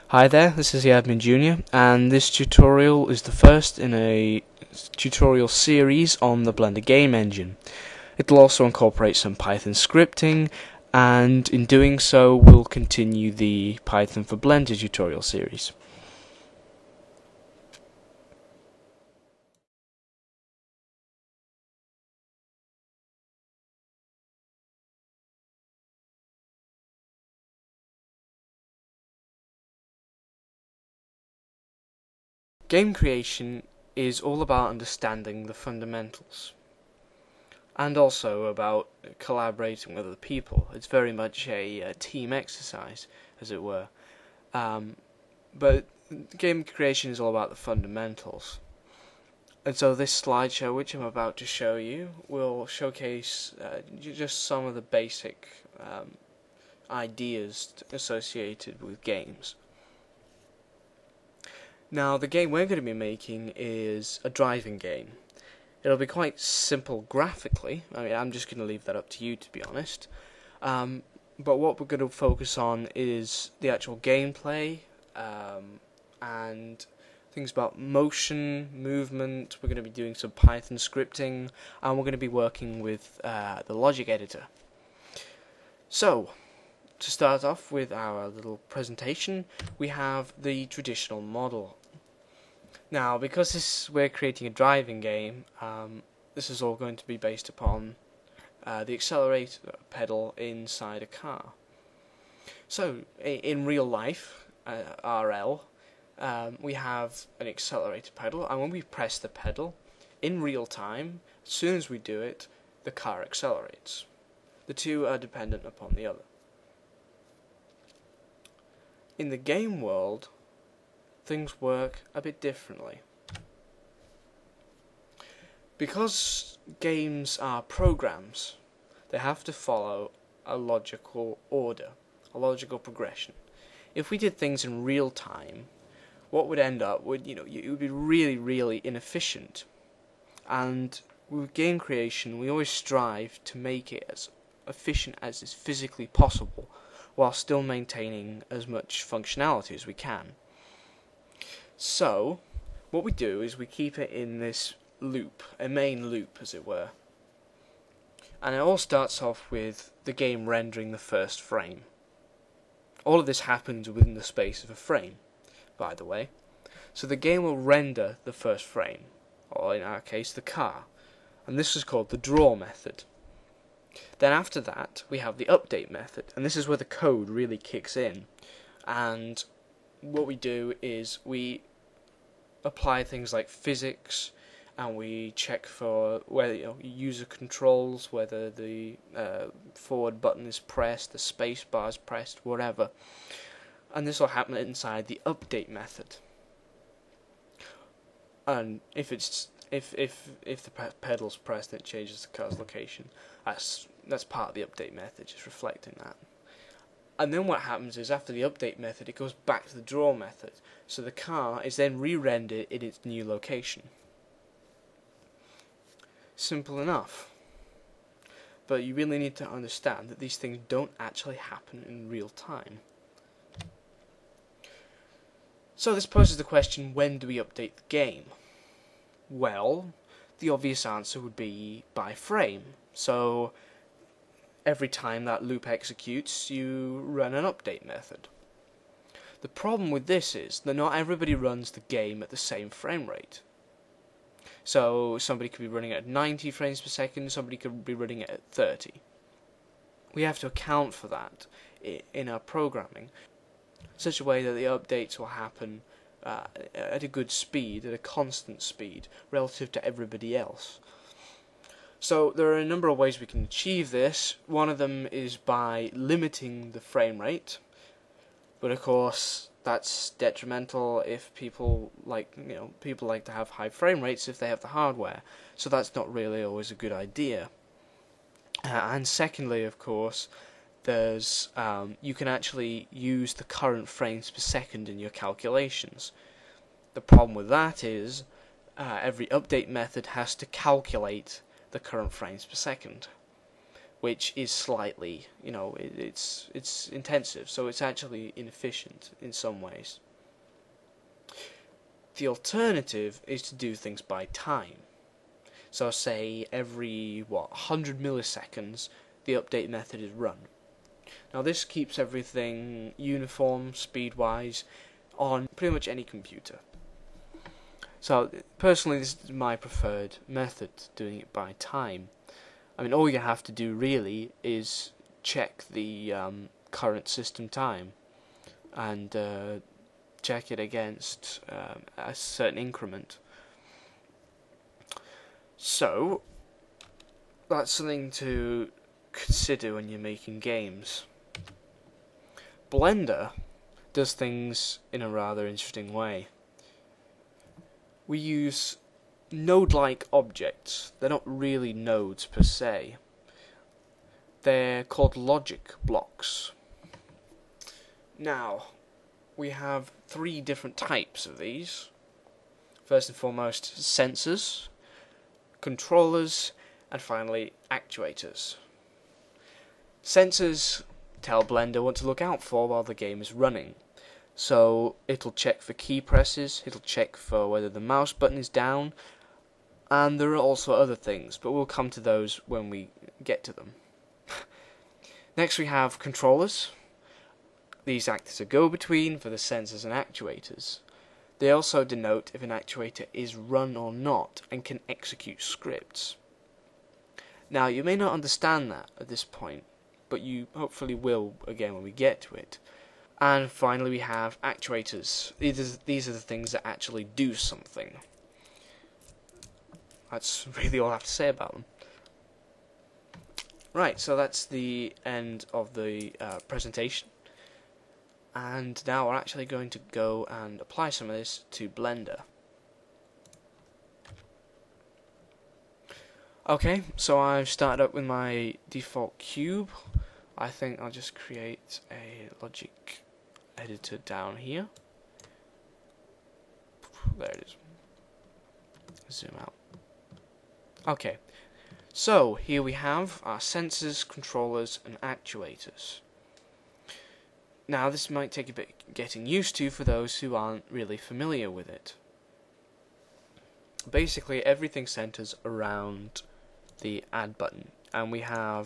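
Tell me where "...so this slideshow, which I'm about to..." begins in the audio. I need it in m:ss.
0:49.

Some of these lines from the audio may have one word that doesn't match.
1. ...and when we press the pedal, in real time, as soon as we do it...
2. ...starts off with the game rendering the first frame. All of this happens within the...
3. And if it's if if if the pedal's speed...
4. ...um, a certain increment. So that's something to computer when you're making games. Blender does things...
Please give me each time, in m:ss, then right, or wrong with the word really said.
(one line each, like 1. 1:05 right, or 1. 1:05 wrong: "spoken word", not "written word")
1. 1:48 right
2. 2:38 right
3. 3:18 wrong: "pressed", not "speed"
4. 5:31 wrong: "consider", not "computer".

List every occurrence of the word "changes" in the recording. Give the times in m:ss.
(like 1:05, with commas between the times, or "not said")
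3:21.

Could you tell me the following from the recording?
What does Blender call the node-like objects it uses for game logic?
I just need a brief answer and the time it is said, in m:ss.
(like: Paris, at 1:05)
Logic blocks, at 5:55.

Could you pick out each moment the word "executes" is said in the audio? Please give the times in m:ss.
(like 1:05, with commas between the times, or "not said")
3:55, 6:34.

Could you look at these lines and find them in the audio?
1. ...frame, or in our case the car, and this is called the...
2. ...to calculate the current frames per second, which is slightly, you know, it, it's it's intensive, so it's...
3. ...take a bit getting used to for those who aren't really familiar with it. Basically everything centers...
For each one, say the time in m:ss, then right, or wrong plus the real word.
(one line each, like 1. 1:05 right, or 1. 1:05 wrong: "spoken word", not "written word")
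1. 2:48 right
2. 4:50 right
3. 7:28 right.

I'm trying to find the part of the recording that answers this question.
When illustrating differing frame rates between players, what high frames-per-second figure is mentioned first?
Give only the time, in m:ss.
4:06.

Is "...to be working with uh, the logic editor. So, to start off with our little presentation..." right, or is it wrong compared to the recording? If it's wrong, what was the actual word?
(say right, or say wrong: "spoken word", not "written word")
right.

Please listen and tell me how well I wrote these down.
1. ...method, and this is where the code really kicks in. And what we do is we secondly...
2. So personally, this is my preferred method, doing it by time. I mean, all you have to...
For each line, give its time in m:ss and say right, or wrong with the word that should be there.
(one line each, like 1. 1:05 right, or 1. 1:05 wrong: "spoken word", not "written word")
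1. 2:55 wrong: "apply", not "secondly"
2. 5:18 right.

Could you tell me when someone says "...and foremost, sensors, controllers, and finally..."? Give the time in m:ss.
6:03.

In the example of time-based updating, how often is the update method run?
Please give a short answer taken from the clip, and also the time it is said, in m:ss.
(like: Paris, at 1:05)
Every 100 milliseconds, at 5:07.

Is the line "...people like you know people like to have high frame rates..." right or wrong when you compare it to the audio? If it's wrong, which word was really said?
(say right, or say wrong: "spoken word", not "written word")
right.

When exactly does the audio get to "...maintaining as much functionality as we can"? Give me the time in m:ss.
2:27.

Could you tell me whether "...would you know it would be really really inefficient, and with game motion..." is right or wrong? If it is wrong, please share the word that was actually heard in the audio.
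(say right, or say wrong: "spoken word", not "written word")
wrong: "creation", not "motion".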